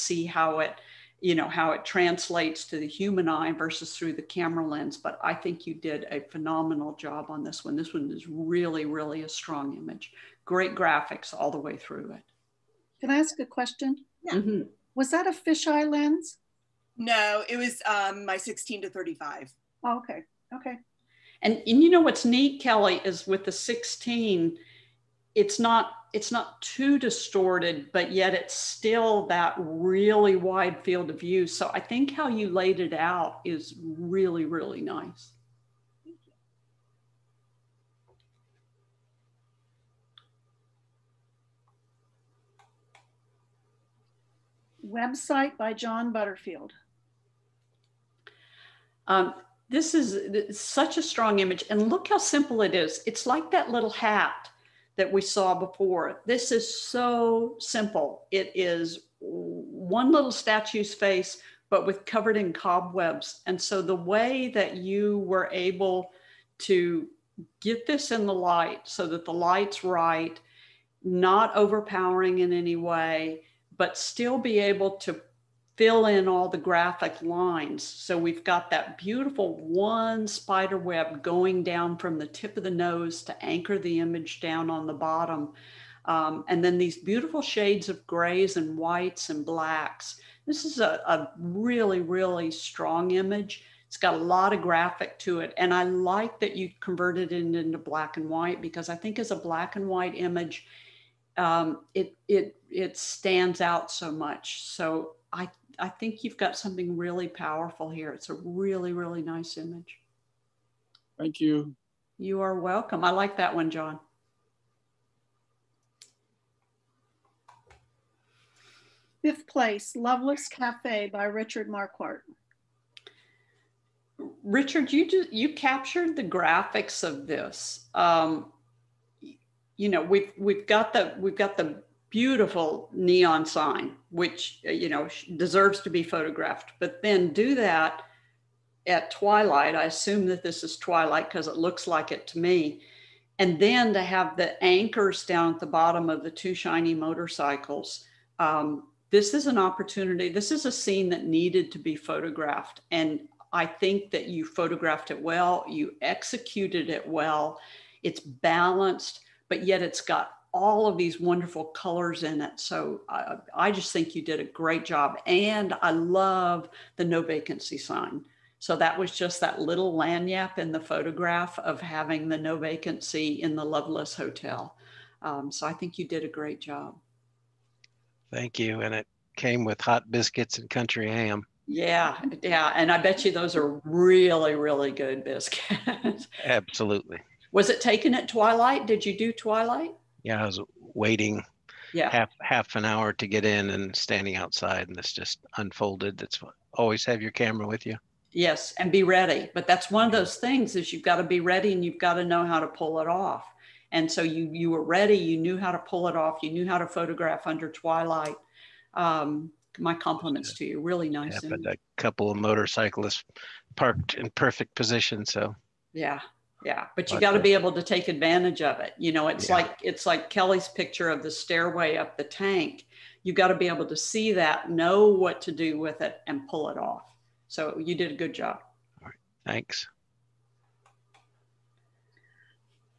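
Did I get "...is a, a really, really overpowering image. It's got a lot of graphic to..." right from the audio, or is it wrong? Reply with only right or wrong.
wrong.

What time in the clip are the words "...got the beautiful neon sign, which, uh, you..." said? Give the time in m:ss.
2:11.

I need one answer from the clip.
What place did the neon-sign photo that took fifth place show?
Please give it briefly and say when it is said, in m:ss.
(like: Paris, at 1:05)
Loveless Cafe, at 1:59.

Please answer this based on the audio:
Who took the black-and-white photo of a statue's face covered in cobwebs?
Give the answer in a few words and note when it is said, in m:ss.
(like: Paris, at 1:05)
John Butterfield, at 0:45.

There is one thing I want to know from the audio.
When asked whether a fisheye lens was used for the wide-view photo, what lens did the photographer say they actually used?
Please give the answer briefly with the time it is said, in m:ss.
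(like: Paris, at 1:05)
16 to 35, at 0:18.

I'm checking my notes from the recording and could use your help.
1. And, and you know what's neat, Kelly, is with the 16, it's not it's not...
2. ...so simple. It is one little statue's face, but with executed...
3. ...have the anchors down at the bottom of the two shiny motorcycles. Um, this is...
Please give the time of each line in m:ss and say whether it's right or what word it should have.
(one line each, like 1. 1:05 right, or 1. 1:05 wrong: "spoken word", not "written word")
1. 0:21 right
2. 0:56 wrong: "covered", not "executed"
3. 2:24 right.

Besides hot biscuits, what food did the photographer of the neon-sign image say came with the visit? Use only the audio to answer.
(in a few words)
country ham.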